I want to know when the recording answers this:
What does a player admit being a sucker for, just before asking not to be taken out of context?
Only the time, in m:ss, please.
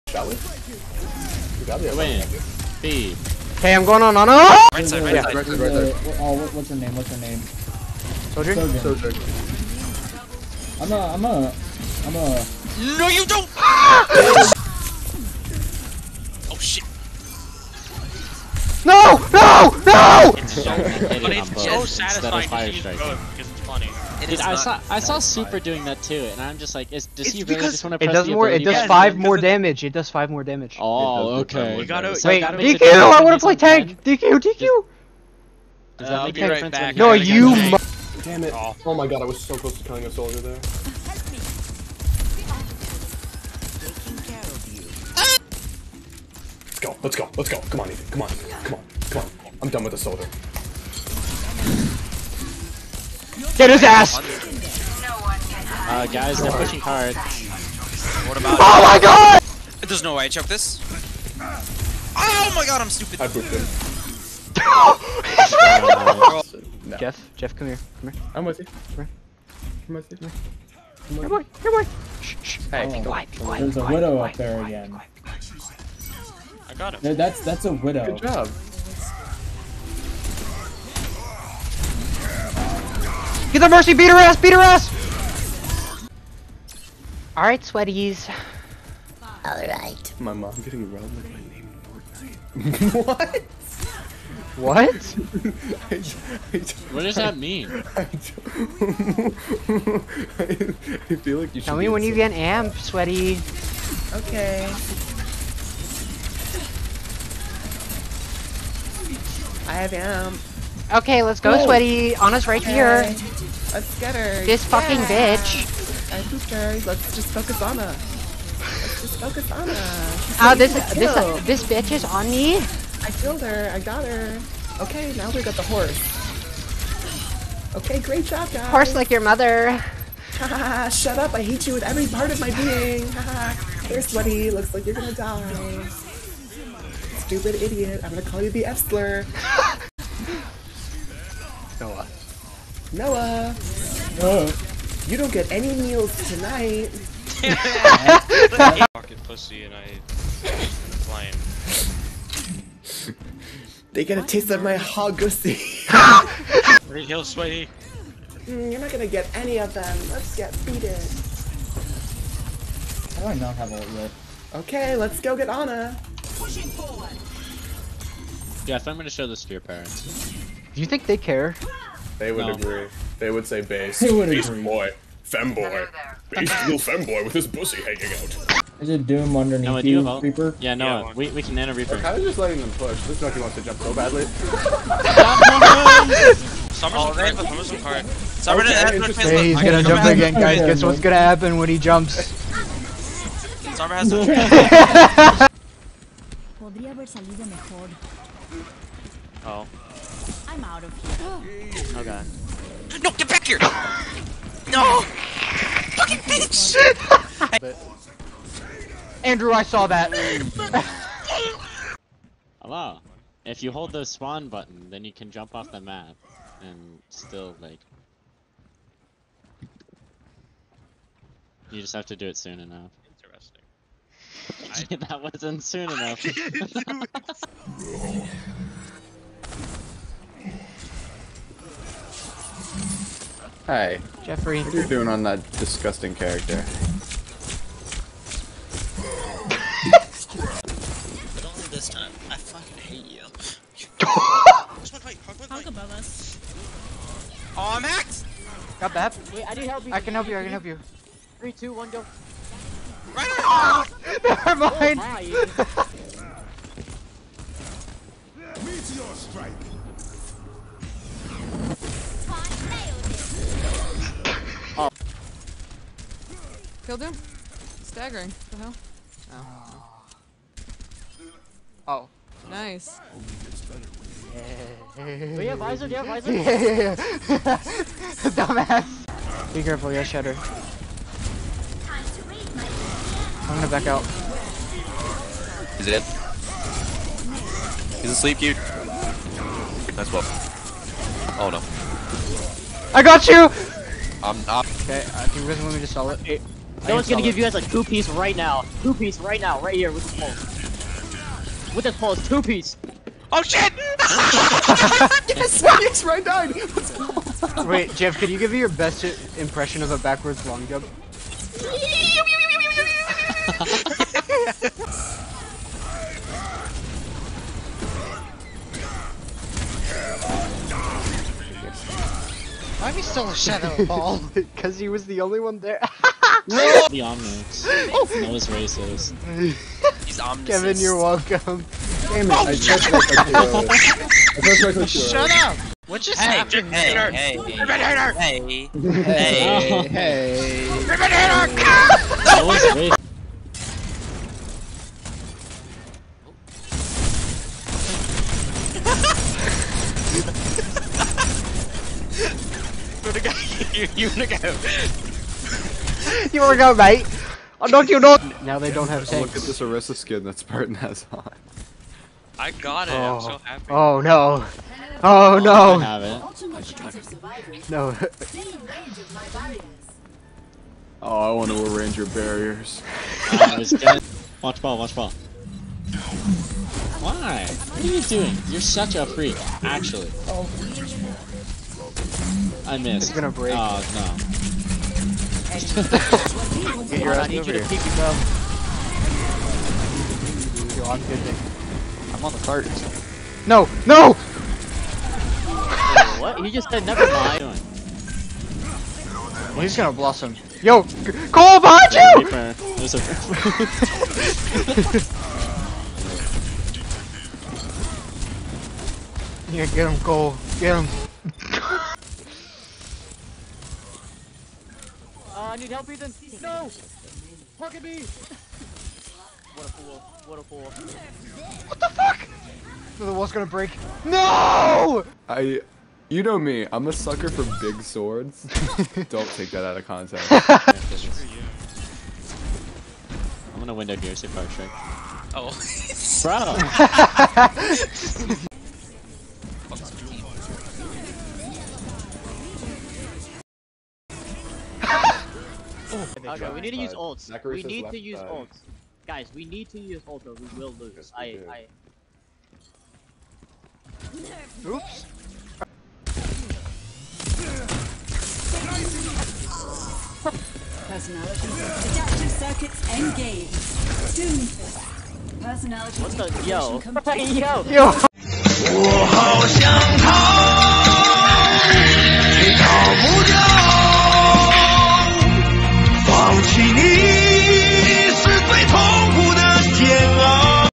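7:07.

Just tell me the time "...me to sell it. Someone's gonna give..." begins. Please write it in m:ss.
4:55.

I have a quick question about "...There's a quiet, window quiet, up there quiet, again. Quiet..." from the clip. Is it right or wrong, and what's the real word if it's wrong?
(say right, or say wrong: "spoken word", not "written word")
wrong: "widow", not "window".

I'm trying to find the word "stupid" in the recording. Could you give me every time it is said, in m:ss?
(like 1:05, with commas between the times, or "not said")
1:02, 2:17.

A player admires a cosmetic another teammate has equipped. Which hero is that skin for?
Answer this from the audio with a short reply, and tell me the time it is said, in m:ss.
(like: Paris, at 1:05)
Orisa, at 5:59.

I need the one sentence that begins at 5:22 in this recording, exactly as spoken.
Why am I still a shadow ball?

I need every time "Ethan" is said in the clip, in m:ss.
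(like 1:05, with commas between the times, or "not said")
0:47, 6:55.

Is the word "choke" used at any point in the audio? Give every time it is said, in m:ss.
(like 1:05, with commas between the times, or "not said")
1:00.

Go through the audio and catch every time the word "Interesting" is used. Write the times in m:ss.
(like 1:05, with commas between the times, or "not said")
3:44.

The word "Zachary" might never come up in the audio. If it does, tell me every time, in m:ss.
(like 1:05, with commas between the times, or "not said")
7:27.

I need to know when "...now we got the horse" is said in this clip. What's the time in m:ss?
2:05.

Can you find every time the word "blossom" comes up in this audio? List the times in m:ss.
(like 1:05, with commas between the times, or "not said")
6:39.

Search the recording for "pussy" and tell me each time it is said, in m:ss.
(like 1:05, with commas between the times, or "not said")
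2:29, 2:35, 2:57.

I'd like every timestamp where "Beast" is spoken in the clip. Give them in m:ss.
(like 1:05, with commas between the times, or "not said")
2:54.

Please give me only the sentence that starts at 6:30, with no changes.
Yo, I'm good, I'm on the cart.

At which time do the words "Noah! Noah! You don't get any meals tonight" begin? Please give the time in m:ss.
2:22.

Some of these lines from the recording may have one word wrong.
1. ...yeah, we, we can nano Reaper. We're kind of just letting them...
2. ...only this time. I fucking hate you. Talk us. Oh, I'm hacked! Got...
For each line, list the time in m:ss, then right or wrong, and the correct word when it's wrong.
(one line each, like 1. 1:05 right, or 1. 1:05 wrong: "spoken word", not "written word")
1. 3:01 right
2. 4:01 right.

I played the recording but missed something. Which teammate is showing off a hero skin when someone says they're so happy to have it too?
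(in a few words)
Spartan.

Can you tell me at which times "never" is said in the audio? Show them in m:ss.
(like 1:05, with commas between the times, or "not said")
4:14, 6:36.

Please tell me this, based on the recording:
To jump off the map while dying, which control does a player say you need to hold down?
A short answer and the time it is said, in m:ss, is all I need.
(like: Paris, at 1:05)
spawn button, at 3:34.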